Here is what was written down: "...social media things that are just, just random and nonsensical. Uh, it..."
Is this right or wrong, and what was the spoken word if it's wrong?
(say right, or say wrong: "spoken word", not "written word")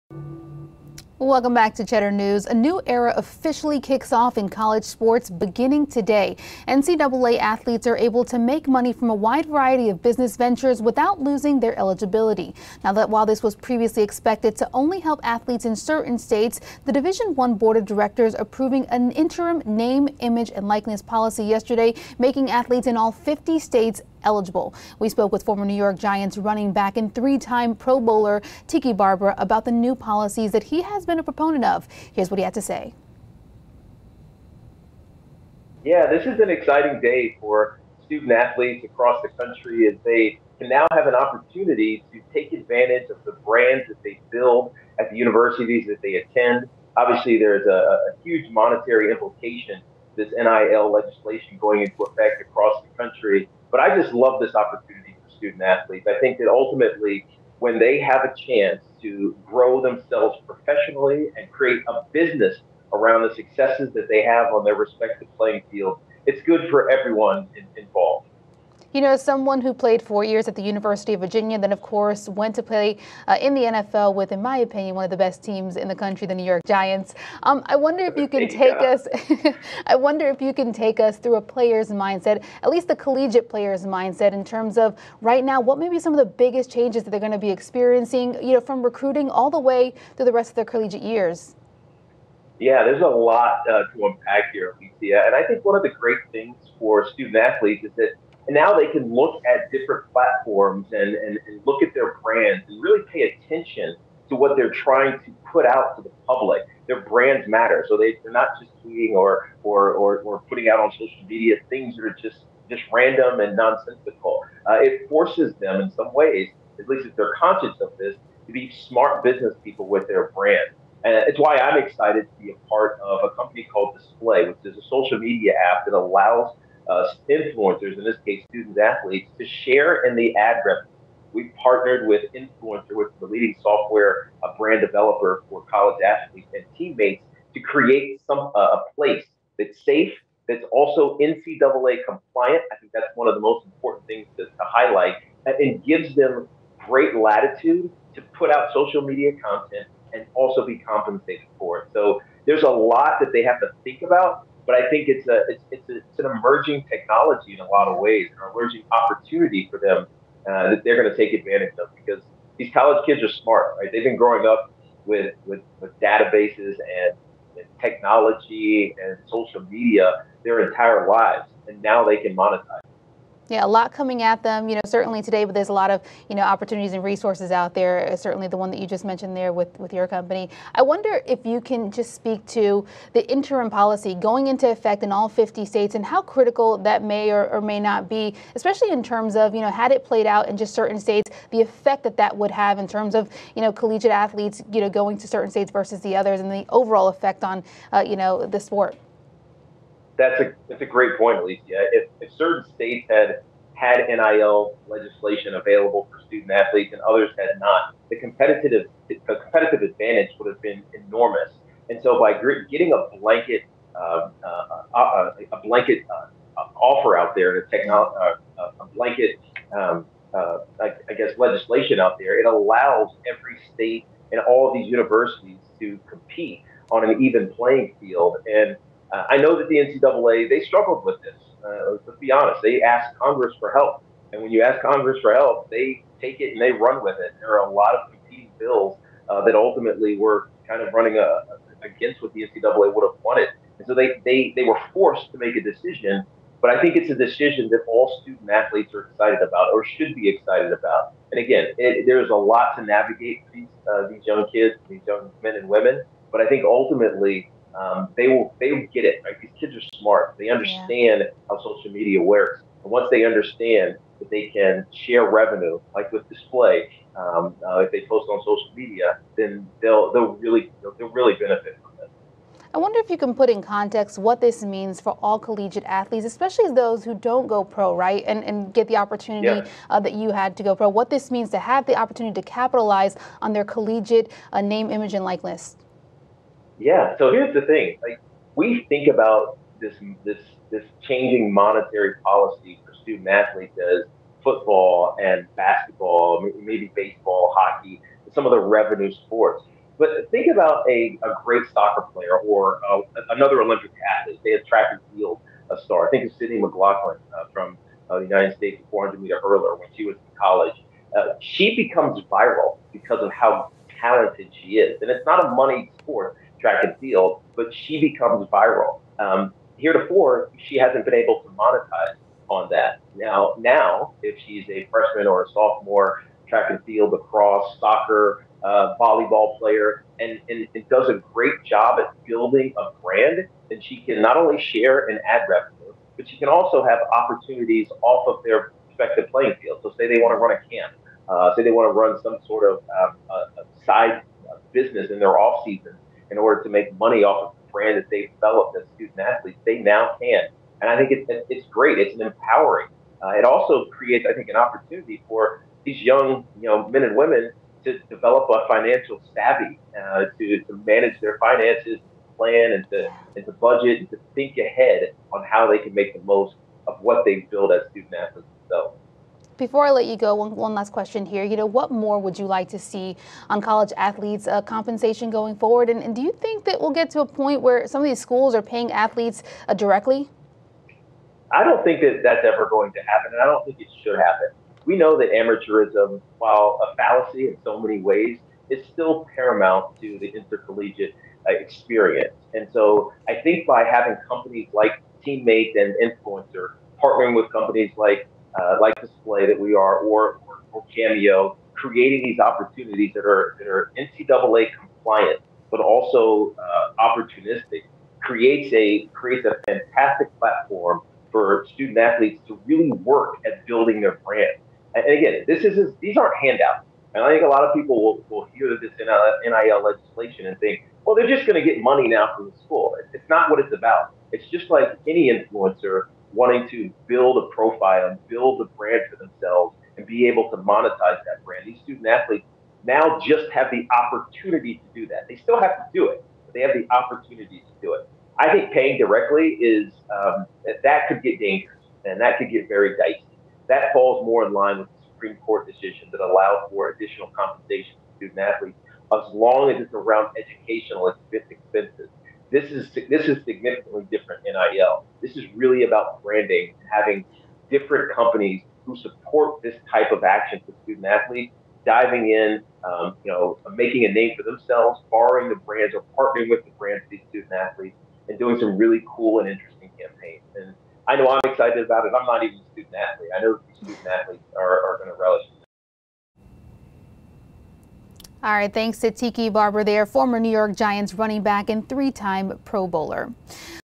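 right.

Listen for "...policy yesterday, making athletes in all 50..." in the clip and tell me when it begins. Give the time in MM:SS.
00:21.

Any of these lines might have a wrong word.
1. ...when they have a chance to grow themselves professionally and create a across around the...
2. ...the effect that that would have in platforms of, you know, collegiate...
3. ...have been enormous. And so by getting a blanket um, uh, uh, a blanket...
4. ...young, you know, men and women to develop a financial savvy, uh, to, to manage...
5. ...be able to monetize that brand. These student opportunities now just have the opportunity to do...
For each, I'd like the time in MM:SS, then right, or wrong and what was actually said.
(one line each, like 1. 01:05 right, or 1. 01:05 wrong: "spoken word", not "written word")
1. 00:57 wrong: "business", not "across"
2. 03:11 wrong: "terms", not "platforms"
3. 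03:30 right
4. 05:56 right
5. 07:10 wrong: "athletes", not "opportunities".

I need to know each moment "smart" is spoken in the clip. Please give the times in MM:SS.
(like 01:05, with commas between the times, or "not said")
01:58, 02:43, 04:19.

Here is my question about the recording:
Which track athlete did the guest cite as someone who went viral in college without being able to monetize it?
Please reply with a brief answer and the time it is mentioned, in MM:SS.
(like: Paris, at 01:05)
Sydney McLaughlin, at 05:06.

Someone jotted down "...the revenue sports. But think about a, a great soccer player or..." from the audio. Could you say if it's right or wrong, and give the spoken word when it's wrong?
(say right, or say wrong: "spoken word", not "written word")
right.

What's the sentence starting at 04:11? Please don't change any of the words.
And again, it, there's a lot to navigate for these, uh, these young kids, these young men and women.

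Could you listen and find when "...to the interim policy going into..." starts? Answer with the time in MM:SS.
03:02.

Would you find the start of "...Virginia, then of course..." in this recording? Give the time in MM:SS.
01:11.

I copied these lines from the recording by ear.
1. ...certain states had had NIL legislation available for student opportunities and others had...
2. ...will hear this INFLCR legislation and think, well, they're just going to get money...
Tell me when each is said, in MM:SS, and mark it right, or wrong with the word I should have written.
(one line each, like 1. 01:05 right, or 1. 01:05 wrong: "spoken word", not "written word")
1. 03:22 wrong: "athletes", not "opportunities"
2. 06:58 wrong: "NIL", not "INFLCR".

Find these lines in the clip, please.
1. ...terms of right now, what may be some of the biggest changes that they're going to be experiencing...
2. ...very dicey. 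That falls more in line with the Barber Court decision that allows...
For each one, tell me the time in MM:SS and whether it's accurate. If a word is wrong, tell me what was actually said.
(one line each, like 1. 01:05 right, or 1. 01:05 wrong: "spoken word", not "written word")
1. 01:24 right
2. 07:22 wrong: "Supreme", not "Barber".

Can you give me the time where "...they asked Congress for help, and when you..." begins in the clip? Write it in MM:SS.
03:52.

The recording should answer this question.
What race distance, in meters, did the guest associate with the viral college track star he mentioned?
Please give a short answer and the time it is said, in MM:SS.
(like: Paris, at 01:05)
400, at 05:08.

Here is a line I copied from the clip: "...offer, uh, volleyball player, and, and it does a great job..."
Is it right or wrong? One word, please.
wrong.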